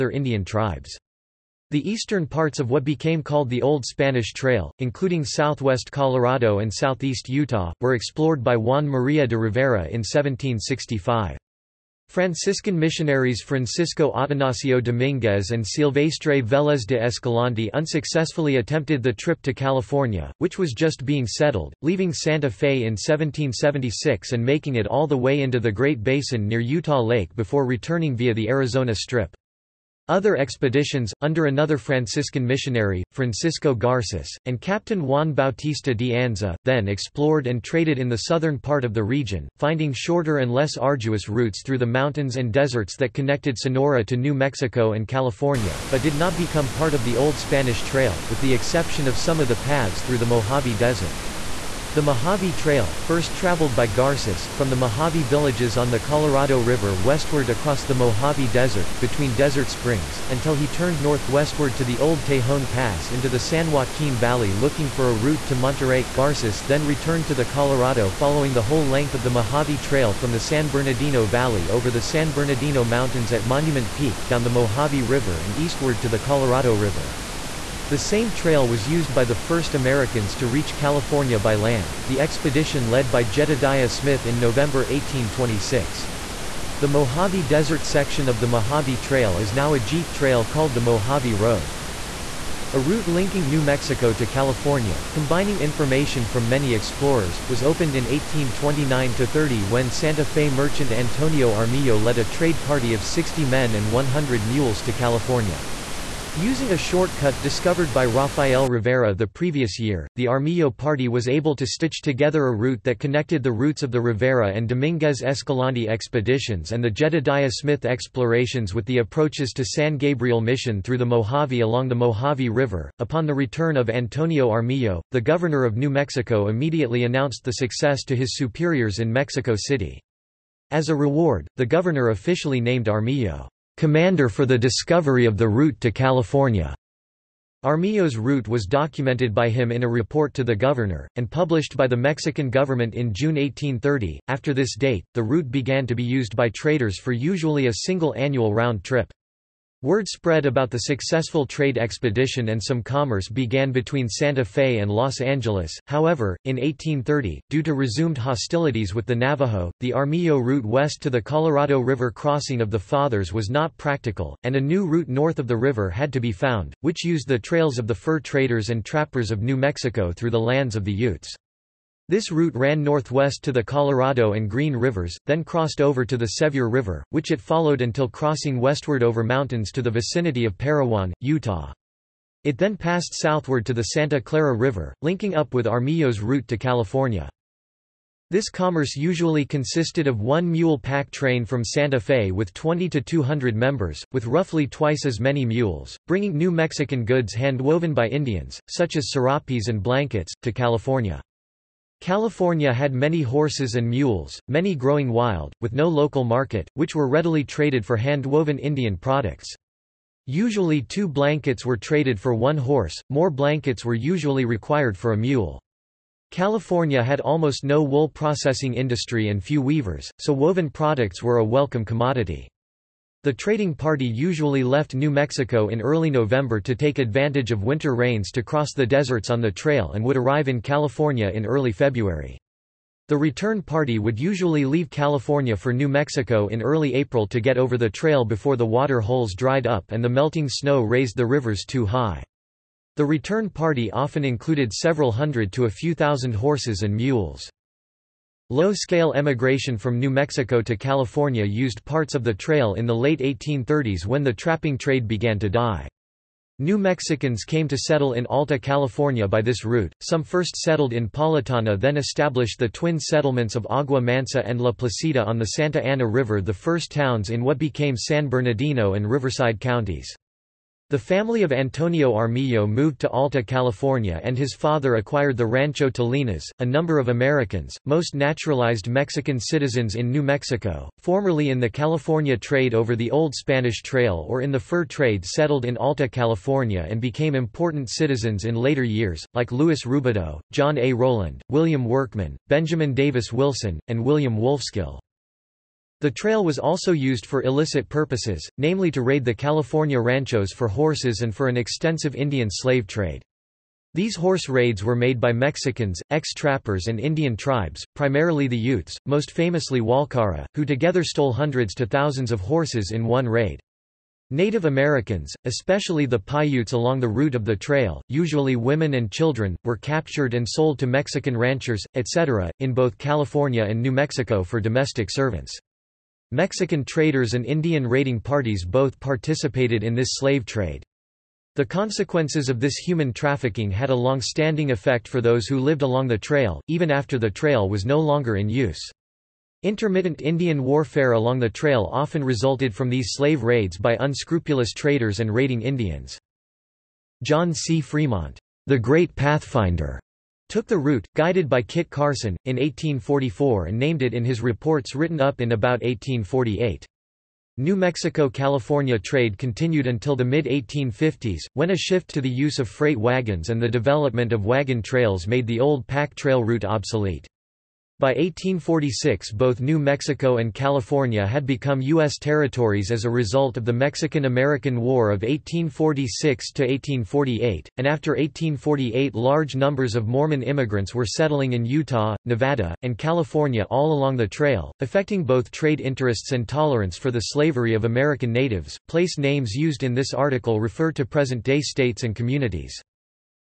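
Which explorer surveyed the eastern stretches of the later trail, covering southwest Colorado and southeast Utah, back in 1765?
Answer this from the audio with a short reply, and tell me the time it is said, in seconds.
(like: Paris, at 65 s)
Juan María de Rivera, at 8 s.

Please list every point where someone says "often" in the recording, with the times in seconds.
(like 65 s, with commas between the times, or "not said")
243 s, 341 s.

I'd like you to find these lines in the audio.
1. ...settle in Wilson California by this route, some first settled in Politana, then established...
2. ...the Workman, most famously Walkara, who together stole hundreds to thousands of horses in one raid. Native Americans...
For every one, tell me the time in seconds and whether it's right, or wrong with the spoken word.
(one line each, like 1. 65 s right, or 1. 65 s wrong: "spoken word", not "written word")
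1. 257 s wrong: "Alta", not "Wilson"
2. 308 s wrong: "Utes", not "Workman".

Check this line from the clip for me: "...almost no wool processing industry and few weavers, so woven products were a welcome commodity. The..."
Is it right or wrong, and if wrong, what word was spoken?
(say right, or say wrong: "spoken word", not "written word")
right.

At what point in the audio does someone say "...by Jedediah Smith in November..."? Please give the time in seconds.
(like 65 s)
83 s.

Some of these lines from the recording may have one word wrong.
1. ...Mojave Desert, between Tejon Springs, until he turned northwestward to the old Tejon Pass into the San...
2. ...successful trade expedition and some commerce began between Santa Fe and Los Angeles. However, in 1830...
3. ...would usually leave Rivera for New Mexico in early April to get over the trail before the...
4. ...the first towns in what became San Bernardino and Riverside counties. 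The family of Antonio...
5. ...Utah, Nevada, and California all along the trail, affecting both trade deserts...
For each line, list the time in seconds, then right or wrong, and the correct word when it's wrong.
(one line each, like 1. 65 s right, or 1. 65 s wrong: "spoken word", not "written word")
1. 57 s wrong: "Desert", not "Tejon"
2. 150 s right
3. 233 s wrong: "California", not "Rivera"
4. 266 s right
5. 381 s wrong: "interests", not "deserts".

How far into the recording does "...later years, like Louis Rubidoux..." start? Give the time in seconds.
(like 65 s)
288 s.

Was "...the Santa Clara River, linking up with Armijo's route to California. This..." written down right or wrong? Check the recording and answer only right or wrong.
right.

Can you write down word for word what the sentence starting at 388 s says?
Place names used in this article refer to present-day states and communities.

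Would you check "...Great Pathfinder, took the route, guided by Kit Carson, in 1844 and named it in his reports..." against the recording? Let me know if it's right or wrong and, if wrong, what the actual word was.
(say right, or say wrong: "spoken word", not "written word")
right.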